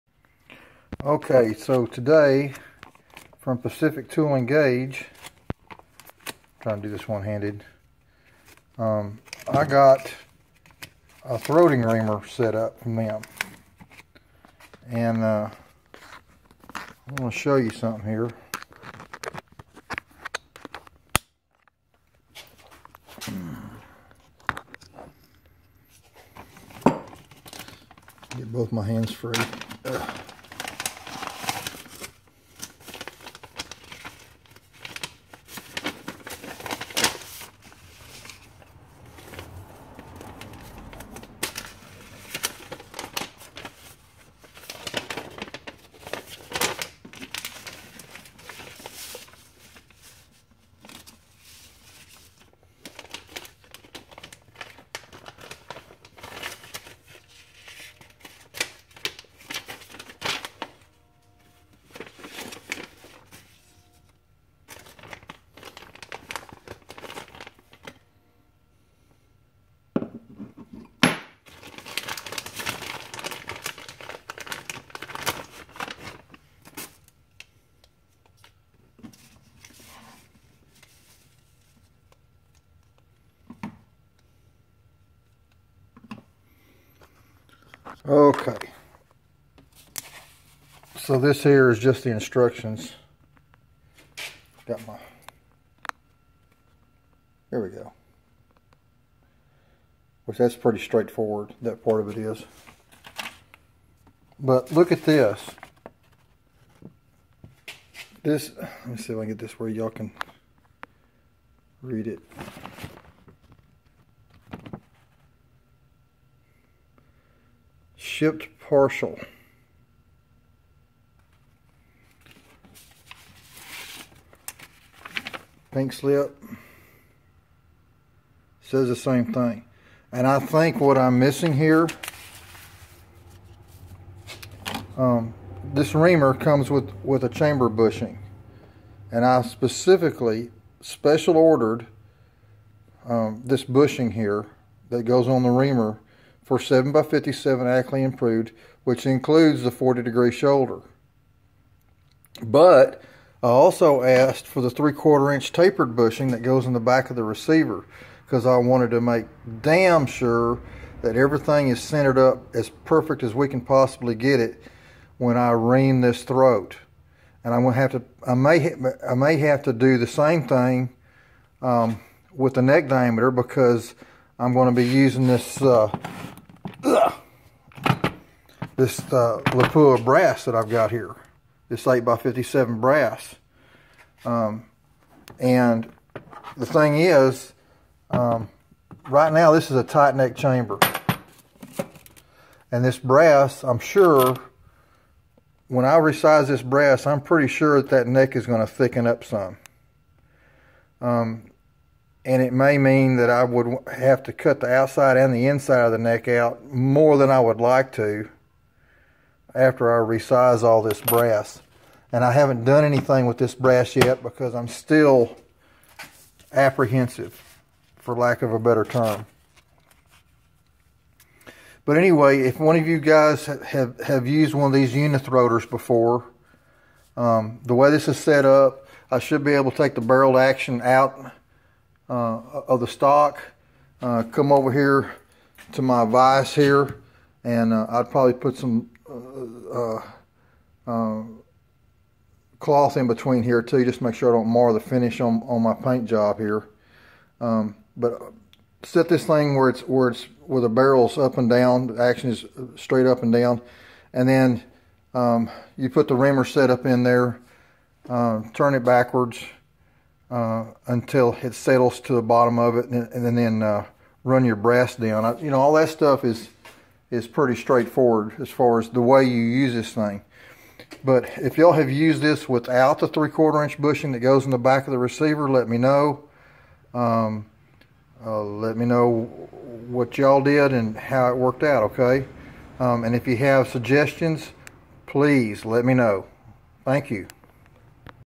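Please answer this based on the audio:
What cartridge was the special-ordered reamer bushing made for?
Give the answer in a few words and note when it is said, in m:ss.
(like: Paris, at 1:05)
7x57 Ackley Improved, at 2:26.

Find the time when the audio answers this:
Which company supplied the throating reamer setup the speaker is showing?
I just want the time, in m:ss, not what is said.
0:03.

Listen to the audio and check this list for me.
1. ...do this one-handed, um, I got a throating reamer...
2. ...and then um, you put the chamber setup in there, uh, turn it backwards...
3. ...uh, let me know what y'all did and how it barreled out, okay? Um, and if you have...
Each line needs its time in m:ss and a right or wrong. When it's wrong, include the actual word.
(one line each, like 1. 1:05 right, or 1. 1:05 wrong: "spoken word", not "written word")
1. 0:06 right
2. 4:14 wrong: "reamer", not "chamber"
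3. 4:38 wrong: "worked", not "barreled".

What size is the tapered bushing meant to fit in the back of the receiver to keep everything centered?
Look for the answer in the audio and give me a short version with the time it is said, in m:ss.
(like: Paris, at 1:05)
3/4 inch, at 4:33.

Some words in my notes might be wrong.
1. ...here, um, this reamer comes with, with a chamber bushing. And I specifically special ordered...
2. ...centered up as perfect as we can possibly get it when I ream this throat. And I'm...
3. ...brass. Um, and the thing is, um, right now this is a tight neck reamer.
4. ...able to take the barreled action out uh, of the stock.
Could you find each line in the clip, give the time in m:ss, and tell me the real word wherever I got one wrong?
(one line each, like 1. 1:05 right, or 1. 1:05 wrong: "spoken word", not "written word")
1. 2:11 right
2. 2:41 right
3. 3:02 wrong: "chamber", not "reamer"
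4. 3:49 right.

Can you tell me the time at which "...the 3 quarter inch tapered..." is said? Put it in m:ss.
2:34.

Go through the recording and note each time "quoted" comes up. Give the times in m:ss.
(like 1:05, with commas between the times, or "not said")
not said.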